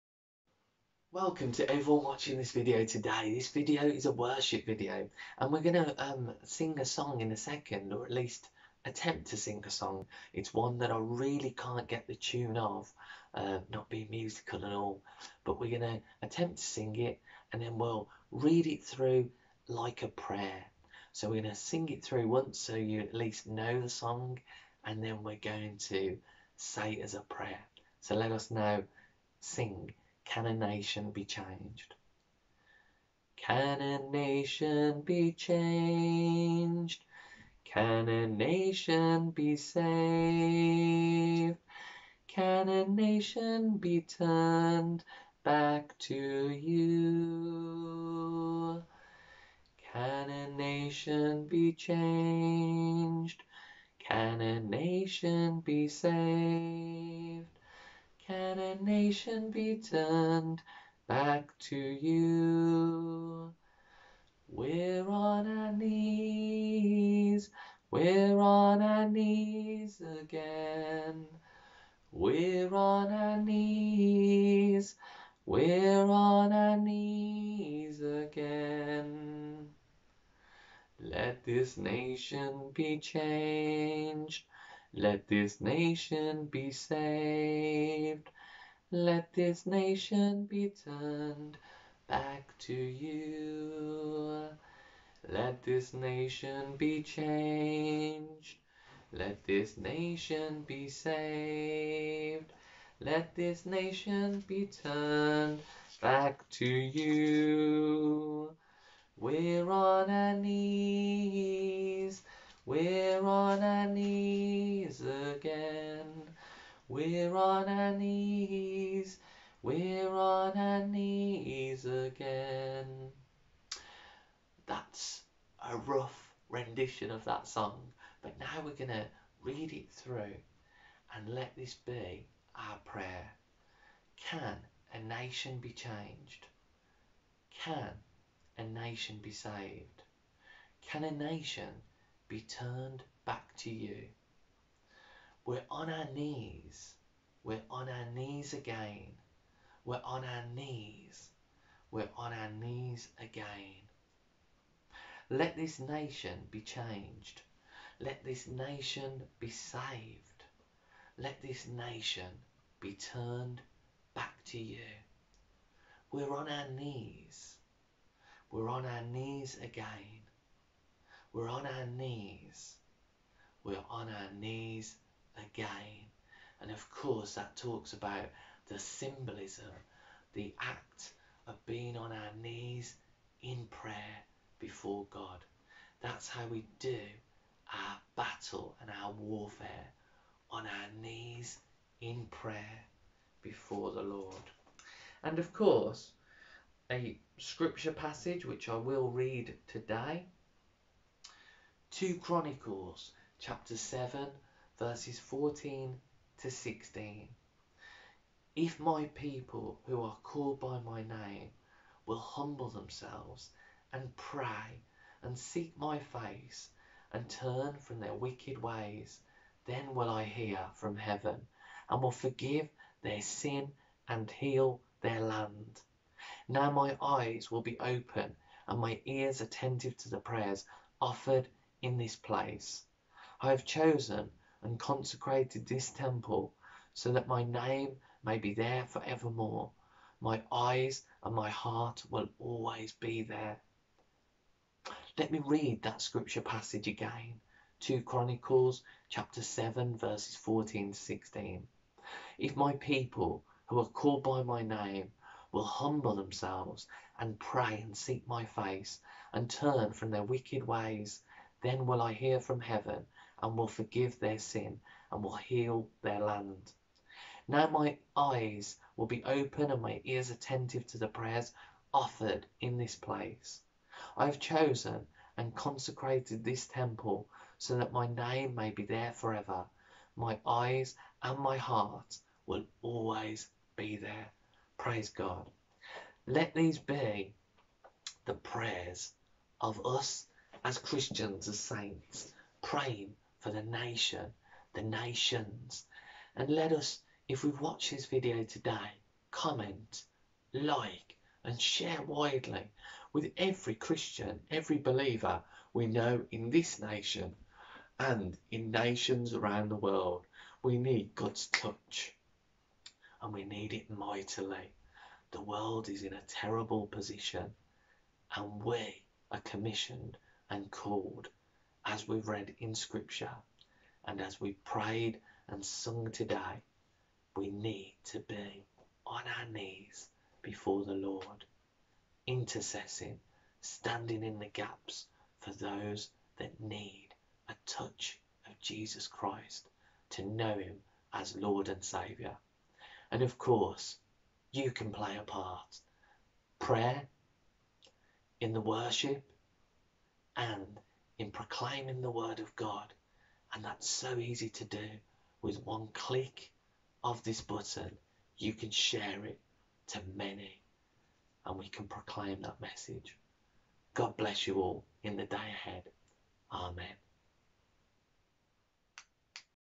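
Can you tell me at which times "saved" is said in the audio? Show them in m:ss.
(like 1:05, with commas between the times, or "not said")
0:39, 0:55, 1:26, 1:40, 2:19, 2:39.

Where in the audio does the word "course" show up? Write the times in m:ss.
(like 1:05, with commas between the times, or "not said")
2:56, 3:15, 5:43.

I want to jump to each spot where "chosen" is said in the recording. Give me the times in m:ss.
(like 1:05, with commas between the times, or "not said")
3:53, 4:34.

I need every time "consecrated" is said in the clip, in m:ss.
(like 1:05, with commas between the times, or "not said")
3:54, 4:35.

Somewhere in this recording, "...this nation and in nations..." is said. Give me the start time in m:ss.
5:06.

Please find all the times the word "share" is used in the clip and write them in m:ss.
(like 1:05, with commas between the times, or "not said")
5:01, 5:58.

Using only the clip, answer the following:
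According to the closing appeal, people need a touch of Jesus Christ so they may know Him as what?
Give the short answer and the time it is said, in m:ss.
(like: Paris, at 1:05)
Lord and Saviour, at 5:41.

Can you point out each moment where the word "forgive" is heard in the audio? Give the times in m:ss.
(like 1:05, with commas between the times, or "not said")
3:42, 4:23.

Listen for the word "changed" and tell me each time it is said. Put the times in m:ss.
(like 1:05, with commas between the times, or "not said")
0:31, 0:35, 0:51, 1:22, 1:37, 2:15, 2:36.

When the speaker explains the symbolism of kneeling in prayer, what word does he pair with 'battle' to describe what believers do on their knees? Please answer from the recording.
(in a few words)
warfare.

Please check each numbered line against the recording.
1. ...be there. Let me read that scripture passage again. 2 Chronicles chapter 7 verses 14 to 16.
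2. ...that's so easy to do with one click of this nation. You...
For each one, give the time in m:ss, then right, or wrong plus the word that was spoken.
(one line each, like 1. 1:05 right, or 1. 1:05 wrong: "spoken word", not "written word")
1. 4:02 right
2. 5:53 wrong: "button", not "nation".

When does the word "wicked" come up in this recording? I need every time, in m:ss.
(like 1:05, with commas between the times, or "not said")
3:38, 4:20.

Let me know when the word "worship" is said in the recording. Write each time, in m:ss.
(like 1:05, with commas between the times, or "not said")
0:04, 5:48.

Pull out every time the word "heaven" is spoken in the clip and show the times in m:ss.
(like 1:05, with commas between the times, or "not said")
3:40, 4:22.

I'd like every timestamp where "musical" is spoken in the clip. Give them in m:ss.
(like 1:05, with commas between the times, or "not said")
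0:14.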